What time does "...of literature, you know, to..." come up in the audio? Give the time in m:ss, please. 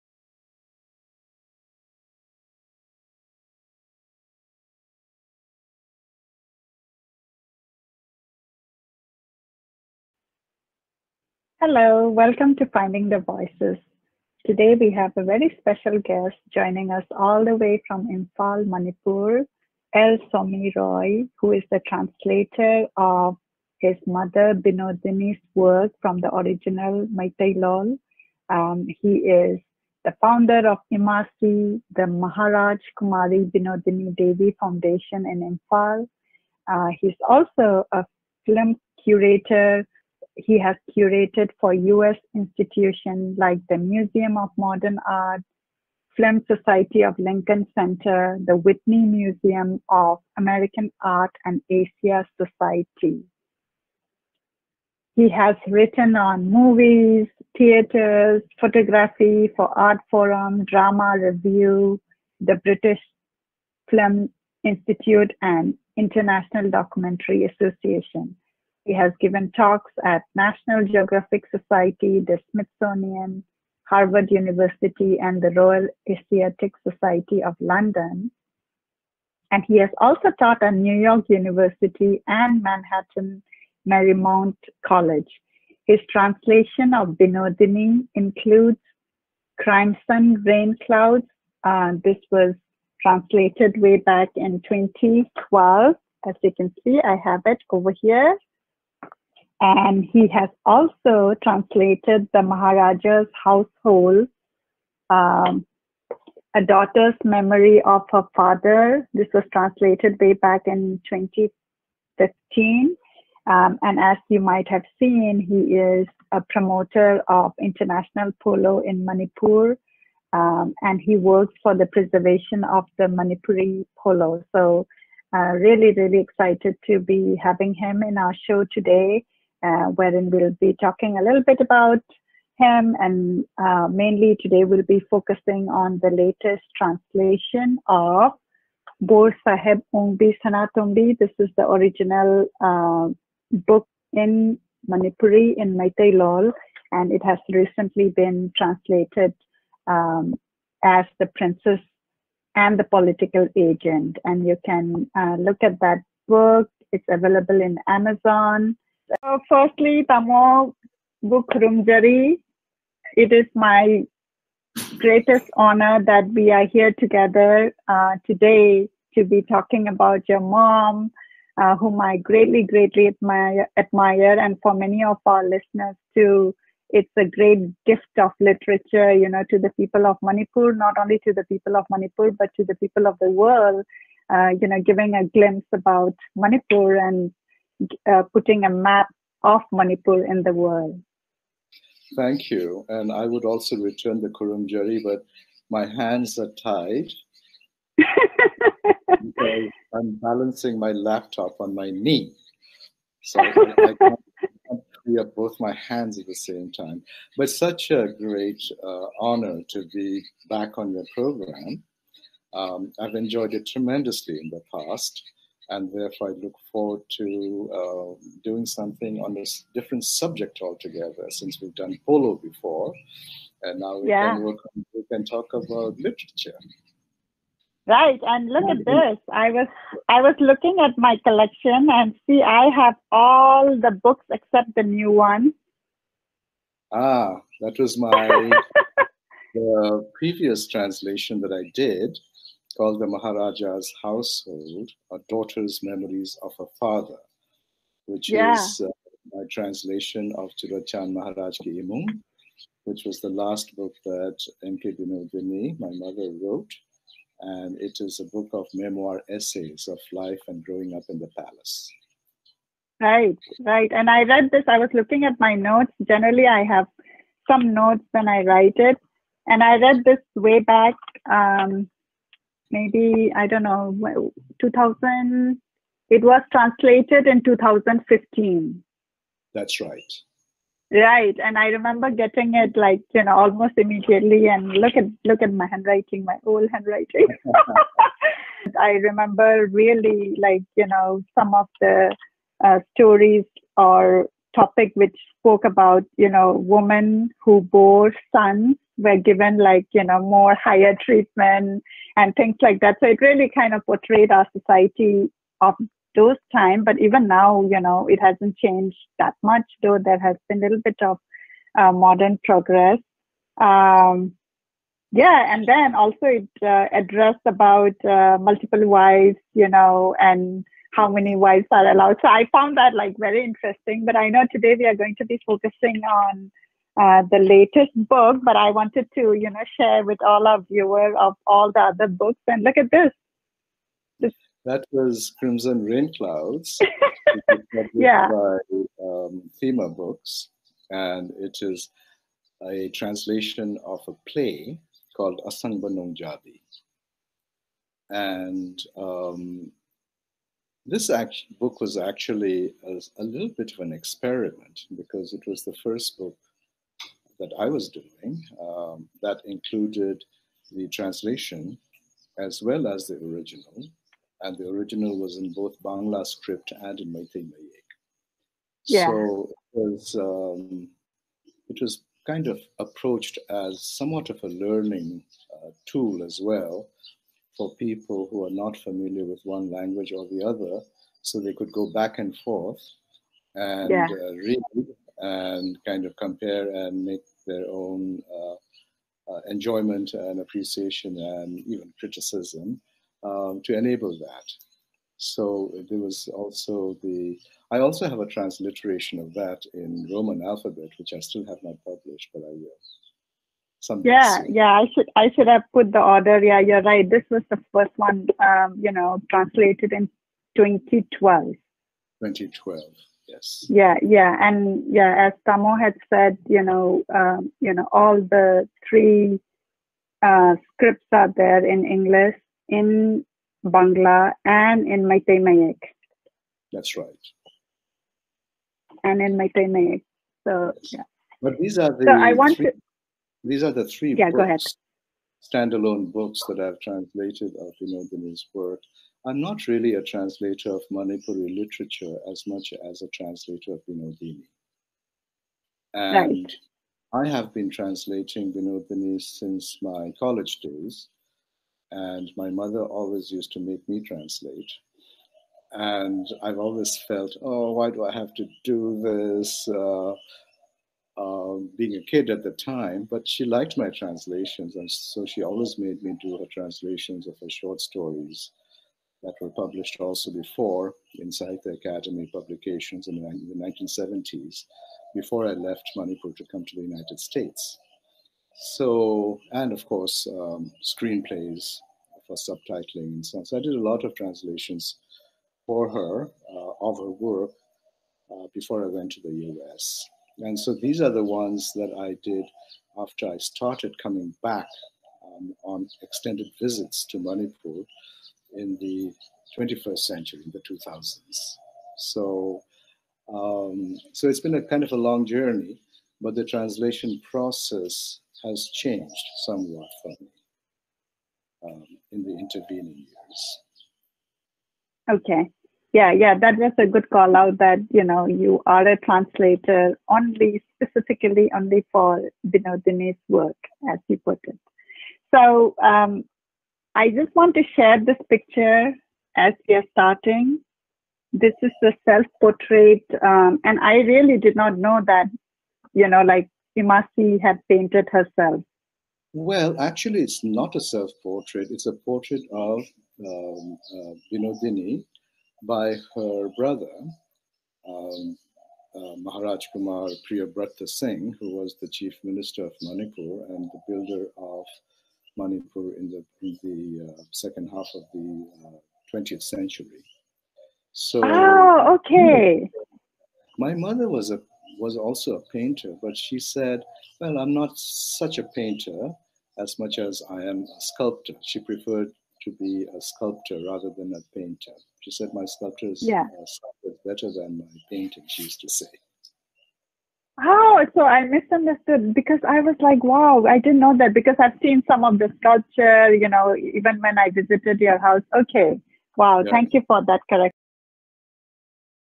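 2:58.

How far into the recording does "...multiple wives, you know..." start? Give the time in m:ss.
5:18.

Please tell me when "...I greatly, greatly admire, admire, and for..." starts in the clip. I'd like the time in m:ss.
2:51.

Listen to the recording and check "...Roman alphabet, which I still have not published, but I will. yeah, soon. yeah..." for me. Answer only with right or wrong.
right.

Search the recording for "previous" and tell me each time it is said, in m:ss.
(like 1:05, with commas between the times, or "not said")
4:00.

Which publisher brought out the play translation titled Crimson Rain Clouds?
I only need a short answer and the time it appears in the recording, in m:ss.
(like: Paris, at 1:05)
Thema Books, at 5:39.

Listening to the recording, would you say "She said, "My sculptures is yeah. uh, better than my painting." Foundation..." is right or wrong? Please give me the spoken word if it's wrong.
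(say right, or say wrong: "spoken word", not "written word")
wrong: "She", not "Foundation".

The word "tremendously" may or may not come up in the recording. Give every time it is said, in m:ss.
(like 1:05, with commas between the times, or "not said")
3:33.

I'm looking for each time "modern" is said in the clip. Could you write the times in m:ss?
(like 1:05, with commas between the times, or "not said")
0:44, 5:11.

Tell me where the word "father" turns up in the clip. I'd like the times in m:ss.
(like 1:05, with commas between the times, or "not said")
1:48, 4:06.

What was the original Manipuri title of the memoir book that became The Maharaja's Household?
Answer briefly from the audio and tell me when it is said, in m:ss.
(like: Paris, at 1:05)
Churachand Maharaj Ki Imung, at 4:10.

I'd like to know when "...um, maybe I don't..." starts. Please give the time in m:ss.
4:31.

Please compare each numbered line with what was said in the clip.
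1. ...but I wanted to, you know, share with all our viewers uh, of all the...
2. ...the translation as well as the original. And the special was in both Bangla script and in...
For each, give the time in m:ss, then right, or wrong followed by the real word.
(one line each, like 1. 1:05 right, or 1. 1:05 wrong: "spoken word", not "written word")
1. 5:28 right
2. 6:00 wrong: "original", not "special".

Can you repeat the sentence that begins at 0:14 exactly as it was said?
Today we have a very special guest joining us all the way from Imphal, Manipur, L.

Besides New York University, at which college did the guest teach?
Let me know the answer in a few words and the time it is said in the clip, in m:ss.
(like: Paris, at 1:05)
Manhattan Marymount College, at 1:22.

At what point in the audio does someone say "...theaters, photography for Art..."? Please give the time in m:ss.
0:57.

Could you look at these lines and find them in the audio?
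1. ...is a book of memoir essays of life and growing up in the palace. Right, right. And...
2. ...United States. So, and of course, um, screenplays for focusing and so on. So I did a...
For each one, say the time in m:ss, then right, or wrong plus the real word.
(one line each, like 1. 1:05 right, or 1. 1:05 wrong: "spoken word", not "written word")
1. 4:18 right
2. 7:56 wrong: "subtitling", not "focusing".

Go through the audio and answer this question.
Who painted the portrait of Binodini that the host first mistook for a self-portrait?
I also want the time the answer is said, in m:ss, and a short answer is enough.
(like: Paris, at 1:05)
Maharaj Kumar Priyobrata Singh, at 9:09.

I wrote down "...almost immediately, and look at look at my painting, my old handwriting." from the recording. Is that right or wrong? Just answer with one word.
wrong.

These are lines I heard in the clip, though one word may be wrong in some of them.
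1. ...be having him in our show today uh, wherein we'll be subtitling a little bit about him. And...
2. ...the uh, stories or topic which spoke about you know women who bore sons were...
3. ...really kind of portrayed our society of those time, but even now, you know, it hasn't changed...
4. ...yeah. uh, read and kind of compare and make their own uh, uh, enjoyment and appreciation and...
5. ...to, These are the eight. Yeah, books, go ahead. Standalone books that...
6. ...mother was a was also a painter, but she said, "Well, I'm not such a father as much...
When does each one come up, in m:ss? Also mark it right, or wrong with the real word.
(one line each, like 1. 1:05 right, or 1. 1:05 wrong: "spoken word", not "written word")
1. 2:06 wrong: "talking", not "subtitling"
2. 4:51 right
3. 5:03 right
4. 6:23 right
5. 7:12 wrong: "three", not "eight"
6. 9:23 wrong: "painter", not "father".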